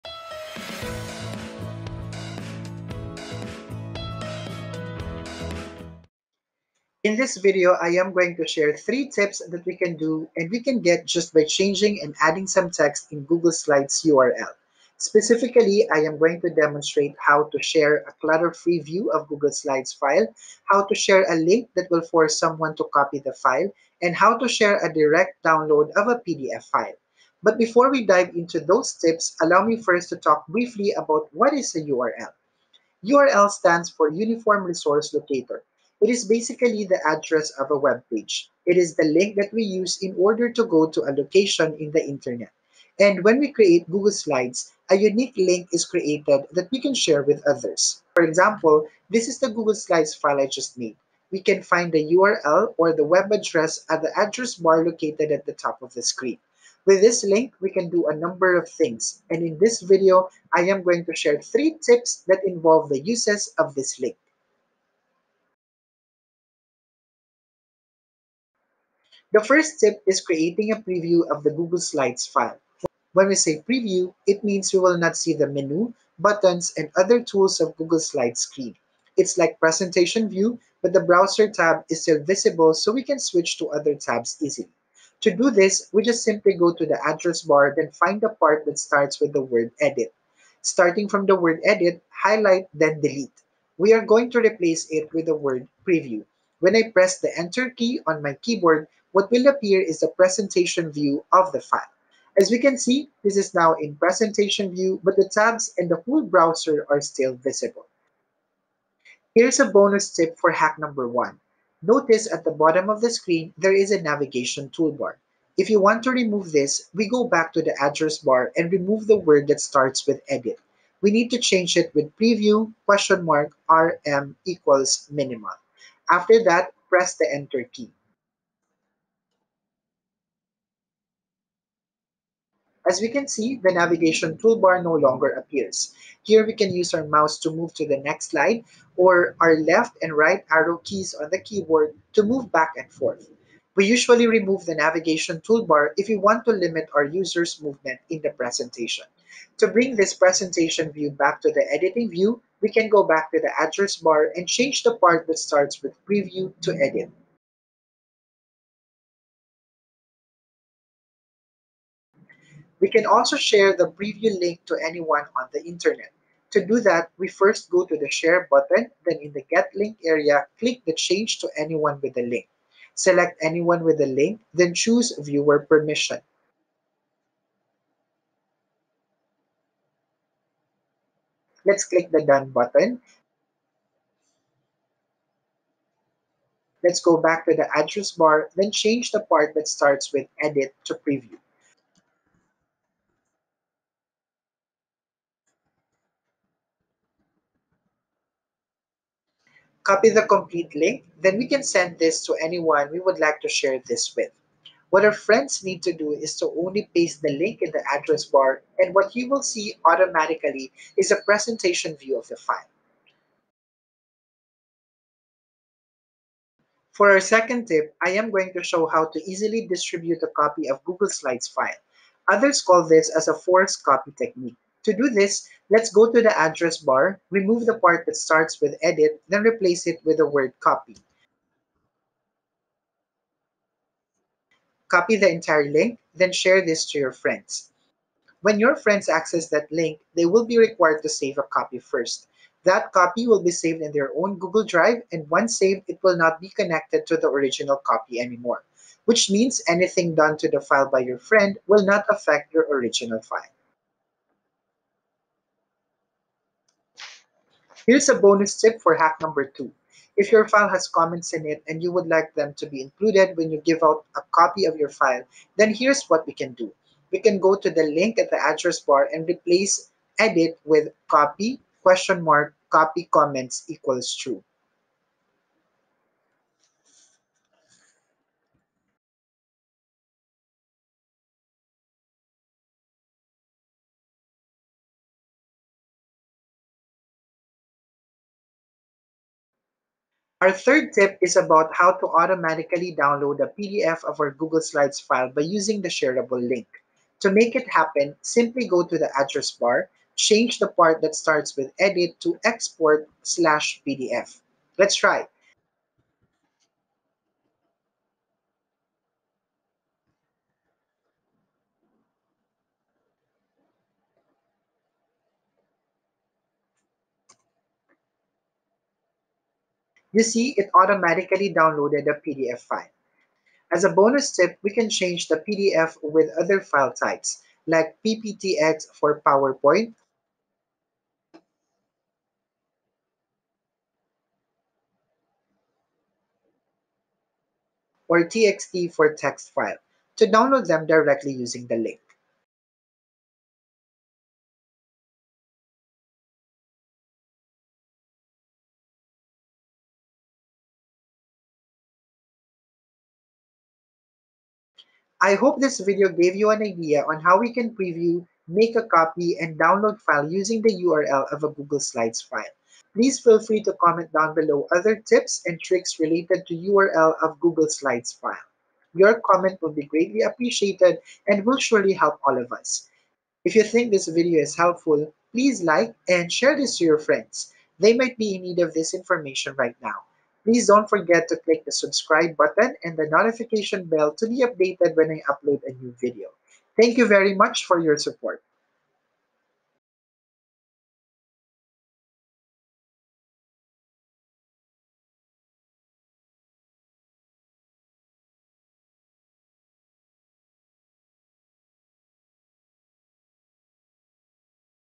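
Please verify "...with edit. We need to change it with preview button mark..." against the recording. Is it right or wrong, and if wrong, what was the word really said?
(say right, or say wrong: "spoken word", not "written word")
wrong: "question", not "button".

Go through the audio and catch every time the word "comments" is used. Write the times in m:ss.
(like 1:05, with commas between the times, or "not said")
4:20, 4:33, 6:03, 6:09.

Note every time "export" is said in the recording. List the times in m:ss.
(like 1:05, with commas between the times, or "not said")
5:02.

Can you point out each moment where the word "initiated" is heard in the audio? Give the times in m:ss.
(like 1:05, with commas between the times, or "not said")
not said.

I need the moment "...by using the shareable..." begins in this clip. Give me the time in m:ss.
4:55.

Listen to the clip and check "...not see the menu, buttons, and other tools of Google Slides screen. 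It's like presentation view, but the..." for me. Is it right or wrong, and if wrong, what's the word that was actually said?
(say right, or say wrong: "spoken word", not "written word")
right.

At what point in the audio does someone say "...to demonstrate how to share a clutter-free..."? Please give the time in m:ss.
0:16.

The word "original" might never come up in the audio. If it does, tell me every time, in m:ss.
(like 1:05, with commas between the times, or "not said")
4:07, 4:12.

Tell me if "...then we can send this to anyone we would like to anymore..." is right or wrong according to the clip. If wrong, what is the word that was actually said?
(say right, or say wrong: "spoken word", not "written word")
wrong: "share", not "anymore".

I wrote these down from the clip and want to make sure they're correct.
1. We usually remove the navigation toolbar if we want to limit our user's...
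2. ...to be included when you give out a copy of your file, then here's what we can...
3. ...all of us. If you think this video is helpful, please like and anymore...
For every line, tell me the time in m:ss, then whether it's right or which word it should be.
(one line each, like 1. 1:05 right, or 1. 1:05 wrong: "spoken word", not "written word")
1. 2:23 right
2. 4:22 right
3. 6:12 wrong: "share", not "anymore".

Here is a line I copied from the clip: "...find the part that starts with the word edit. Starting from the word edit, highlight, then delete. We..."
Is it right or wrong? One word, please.
right.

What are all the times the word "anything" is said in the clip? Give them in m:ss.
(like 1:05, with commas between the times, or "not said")
4:09.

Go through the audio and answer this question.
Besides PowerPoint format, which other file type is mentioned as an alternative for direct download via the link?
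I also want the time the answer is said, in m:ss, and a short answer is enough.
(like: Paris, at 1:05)
TXT, at 5:38.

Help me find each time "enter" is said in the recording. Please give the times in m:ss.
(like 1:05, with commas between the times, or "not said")
1:37, 2:07.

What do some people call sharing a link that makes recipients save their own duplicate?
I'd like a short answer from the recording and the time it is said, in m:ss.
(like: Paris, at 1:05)
forced copy technique, at 3:43.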